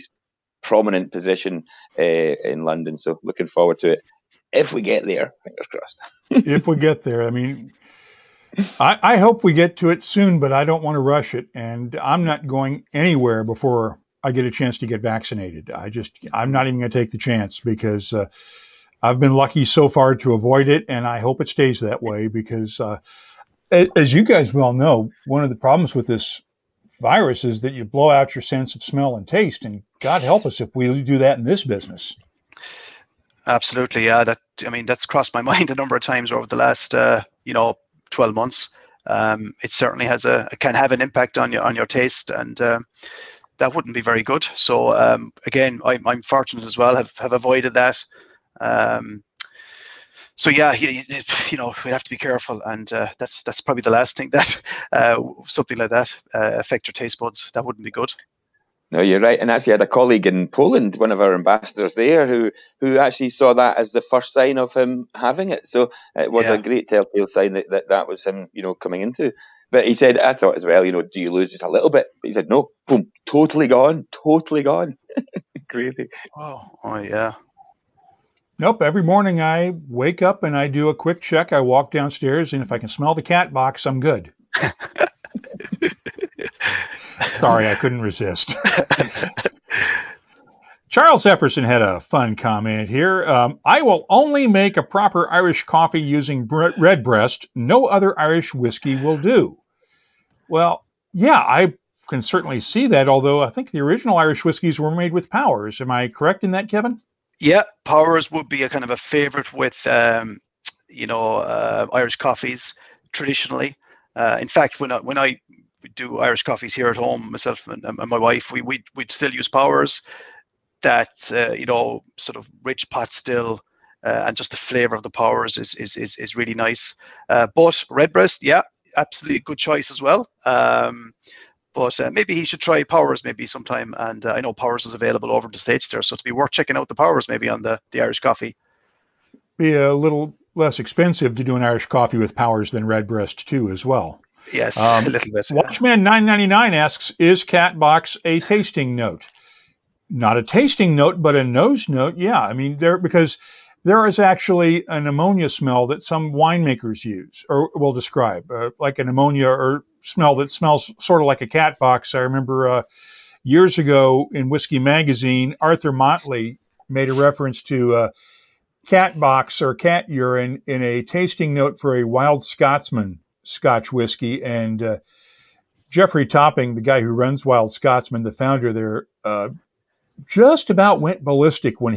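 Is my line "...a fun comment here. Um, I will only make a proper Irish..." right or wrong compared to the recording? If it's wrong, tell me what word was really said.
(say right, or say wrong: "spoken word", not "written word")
right.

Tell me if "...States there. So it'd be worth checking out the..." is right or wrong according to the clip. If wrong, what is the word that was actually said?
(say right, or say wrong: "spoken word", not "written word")
right.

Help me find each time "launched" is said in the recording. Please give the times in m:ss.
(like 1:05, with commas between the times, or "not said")
not said.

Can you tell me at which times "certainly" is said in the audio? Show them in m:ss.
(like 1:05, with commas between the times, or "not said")
0:39, 1:42.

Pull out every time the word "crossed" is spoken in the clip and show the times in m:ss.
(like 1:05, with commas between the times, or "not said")
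0:05, 0:35.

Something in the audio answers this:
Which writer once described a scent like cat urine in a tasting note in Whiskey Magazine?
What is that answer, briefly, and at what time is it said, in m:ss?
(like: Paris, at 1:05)
Arthur Motley, at 2:45.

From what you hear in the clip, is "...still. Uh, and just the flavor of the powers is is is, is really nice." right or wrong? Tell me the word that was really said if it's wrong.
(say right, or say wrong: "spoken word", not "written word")
right.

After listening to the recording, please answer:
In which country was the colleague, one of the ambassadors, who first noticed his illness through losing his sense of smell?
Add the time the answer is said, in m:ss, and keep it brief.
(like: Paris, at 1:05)
Poland, at 1:00.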